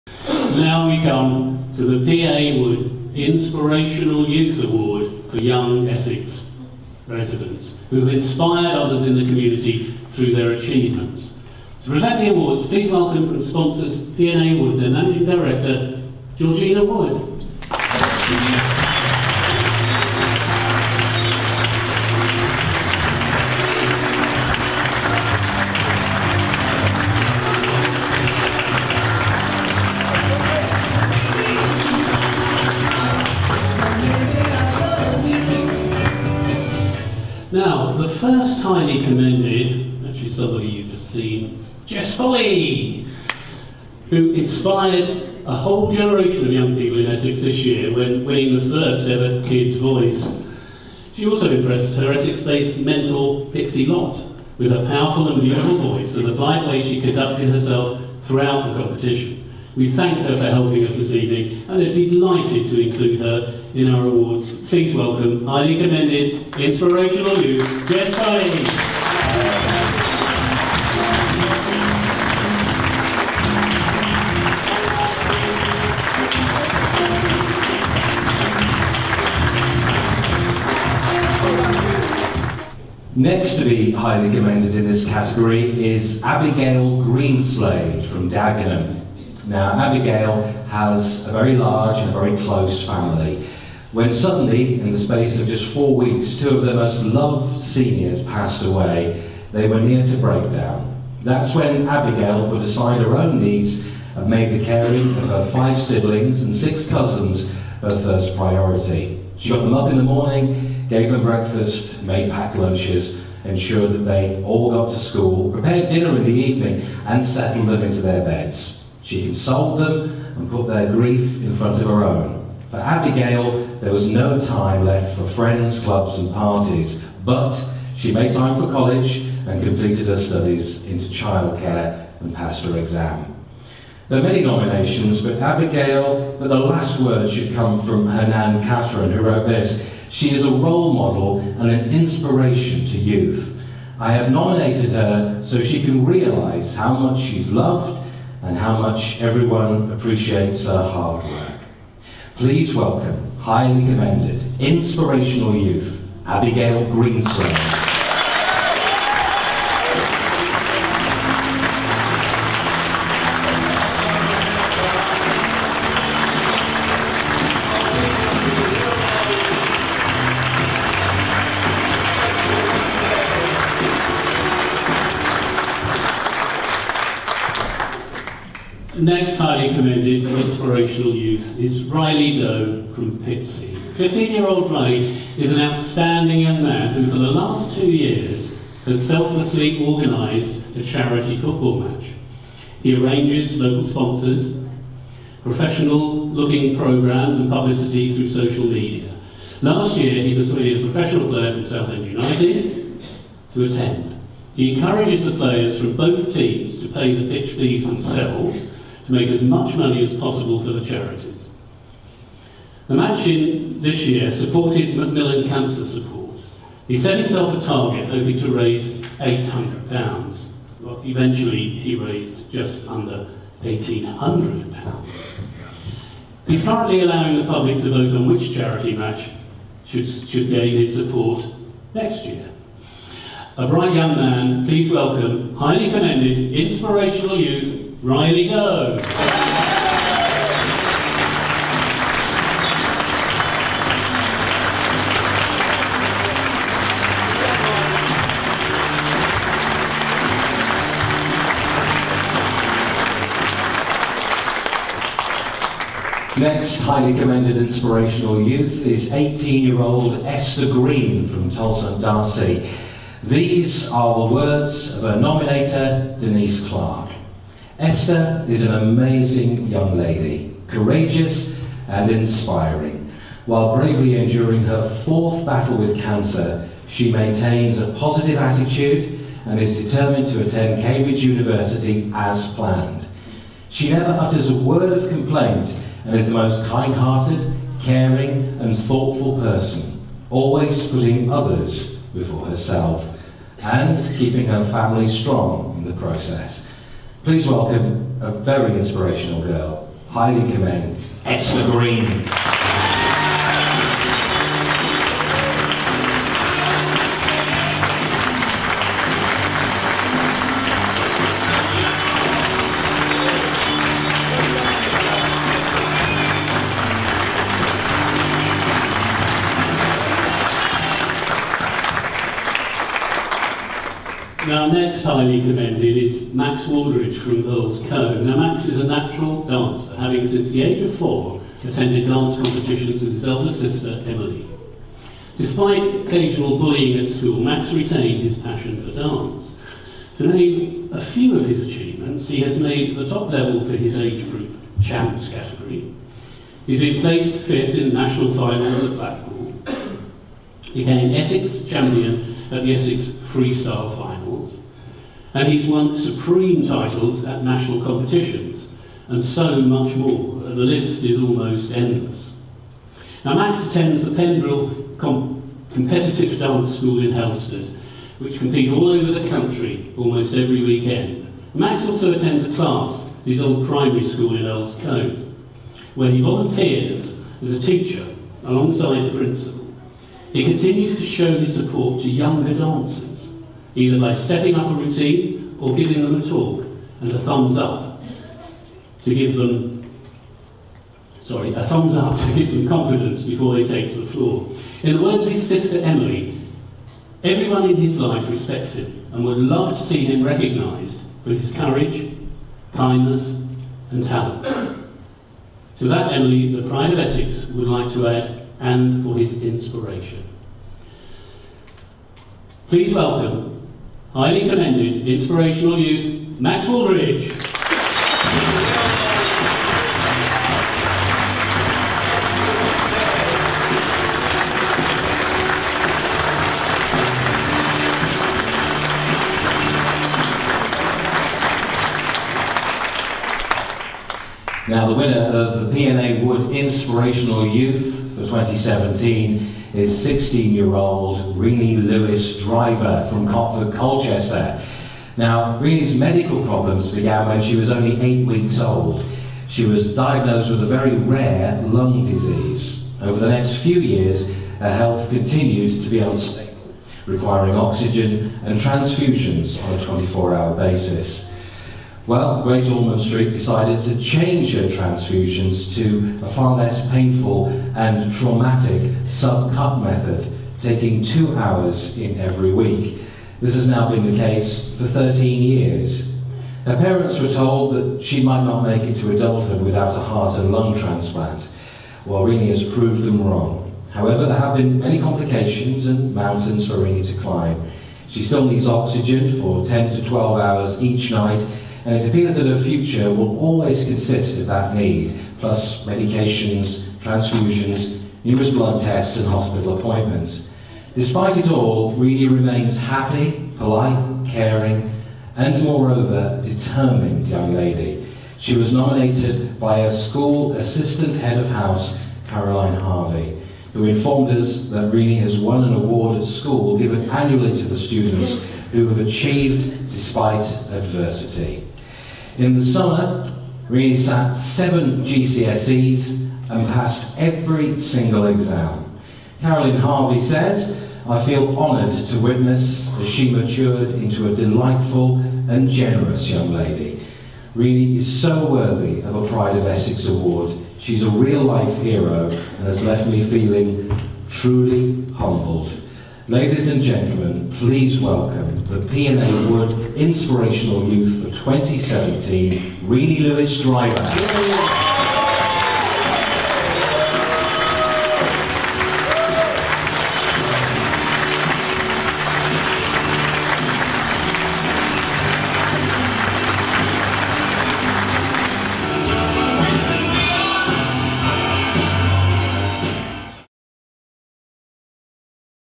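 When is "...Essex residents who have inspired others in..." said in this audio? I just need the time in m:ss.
0:05.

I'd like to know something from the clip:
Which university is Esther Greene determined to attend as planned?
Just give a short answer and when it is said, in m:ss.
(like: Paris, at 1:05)
Cambridge University, at 4:40.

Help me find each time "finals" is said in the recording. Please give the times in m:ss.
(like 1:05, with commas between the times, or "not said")
5:48, 5:53.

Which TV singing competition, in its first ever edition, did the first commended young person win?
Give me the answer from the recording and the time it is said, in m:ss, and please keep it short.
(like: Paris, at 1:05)
Kids Voice, at 0:49.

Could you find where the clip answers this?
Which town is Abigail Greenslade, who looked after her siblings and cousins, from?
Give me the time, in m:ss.
1:28.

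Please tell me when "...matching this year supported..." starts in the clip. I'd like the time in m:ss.
3:32.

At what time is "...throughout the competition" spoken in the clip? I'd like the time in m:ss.
0:58.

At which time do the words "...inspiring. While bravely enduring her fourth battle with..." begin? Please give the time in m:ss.
4:32.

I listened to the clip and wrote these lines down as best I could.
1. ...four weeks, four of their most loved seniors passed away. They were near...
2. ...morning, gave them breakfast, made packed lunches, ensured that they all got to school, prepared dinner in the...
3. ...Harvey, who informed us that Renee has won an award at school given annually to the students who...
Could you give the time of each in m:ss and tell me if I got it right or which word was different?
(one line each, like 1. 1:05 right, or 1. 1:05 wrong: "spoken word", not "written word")
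1. 1:35 wrong: "two", not "four"
2. 1:50 right
3. 8:32 right.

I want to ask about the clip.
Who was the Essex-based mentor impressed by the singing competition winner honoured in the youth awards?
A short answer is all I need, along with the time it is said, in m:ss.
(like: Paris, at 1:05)
Pixie Lott, at 0:53.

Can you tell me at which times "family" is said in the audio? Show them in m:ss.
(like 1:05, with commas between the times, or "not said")
1:32, 4:54.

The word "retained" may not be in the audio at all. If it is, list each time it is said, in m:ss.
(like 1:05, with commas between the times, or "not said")
5:37.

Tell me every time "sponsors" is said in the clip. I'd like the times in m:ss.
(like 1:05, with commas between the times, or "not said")
0:13, 3:13.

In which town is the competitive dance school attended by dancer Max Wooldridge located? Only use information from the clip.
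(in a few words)
Halstead.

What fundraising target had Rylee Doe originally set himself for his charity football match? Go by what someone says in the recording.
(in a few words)
£800.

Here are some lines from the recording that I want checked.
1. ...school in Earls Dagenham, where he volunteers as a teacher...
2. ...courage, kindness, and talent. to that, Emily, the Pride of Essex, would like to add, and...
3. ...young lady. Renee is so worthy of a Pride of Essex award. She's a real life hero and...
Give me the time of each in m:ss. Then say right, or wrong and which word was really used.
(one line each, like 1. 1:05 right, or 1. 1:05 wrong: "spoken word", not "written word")
1. 6:14 wrong: "Colne", not "Dagenham"
2. 6:41 right
3. 8:56 right.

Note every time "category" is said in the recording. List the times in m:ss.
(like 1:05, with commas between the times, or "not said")
1:25, 5:45.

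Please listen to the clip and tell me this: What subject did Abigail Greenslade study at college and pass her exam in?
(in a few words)
Childcare.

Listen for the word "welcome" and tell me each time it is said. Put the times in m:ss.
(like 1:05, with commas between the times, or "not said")
0:12, 1:04, 2:32, 3:54, 4:57, 6:52, 9:07.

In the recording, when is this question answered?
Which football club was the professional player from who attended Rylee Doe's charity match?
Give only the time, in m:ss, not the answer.
3:21.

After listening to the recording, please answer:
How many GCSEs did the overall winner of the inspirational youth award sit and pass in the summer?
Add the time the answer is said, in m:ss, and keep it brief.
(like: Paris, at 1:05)
7, at 8:44.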